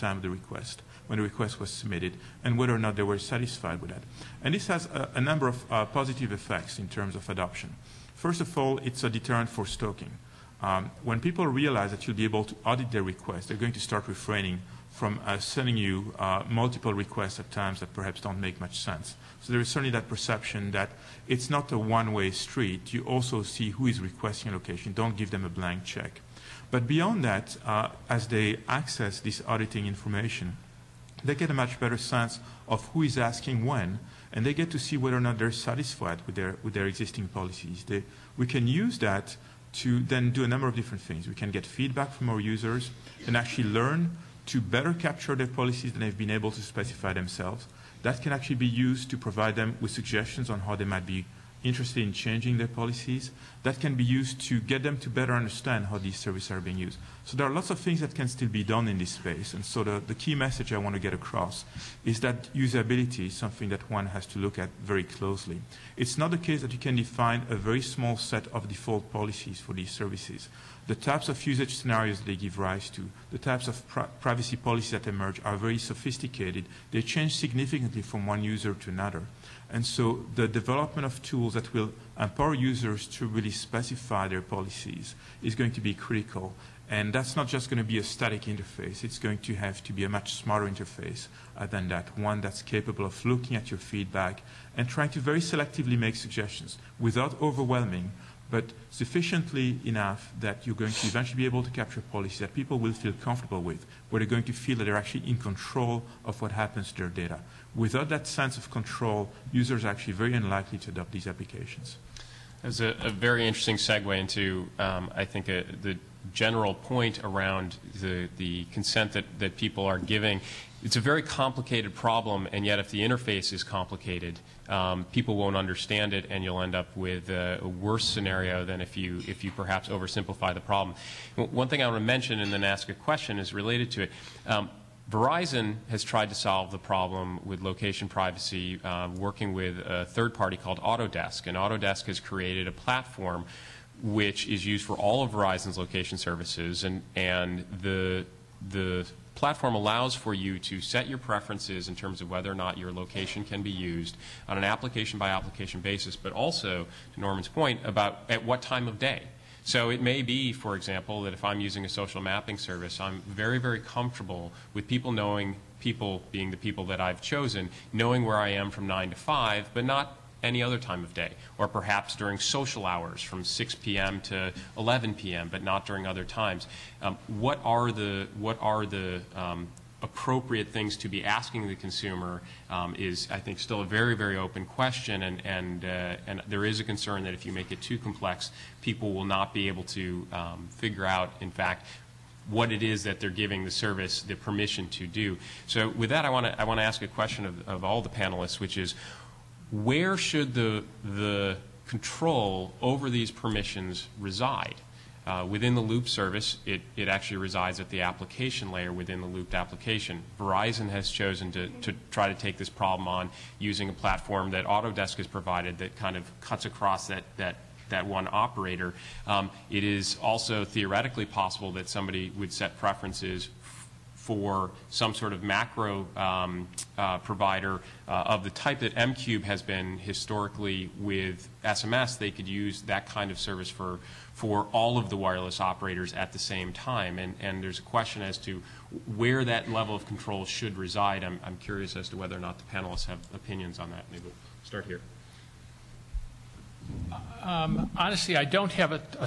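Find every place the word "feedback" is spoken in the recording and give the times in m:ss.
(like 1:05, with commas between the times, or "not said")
0:41, 1:33.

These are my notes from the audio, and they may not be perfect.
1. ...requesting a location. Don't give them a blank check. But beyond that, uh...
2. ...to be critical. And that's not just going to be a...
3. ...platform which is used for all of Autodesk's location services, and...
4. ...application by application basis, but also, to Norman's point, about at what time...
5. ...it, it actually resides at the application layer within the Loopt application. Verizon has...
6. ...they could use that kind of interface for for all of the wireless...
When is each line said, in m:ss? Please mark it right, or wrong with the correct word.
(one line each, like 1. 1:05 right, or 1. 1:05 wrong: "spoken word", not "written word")
1. 0:23 right
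2. 1:25 right
3. 2:22 wrong: "Verizon", not "Autodesk"
4. 2:34 right
5. 3:26 right
6. 3:52 wrong: "service", not "interface".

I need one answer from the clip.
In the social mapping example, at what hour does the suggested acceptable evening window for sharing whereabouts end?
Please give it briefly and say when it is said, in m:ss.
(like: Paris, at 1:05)
11 p.m., at 2:54.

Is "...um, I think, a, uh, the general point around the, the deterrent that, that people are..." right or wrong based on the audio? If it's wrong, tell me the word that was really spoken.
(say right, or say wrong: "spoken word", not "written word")
wrong: "consent", not "deterrent".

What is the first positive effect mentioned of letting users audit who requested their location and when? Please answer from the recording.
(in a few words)
Deterrent for stalking.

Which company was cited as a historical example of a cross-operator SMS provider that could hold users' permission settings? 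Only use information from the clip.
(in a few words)
m-Qube.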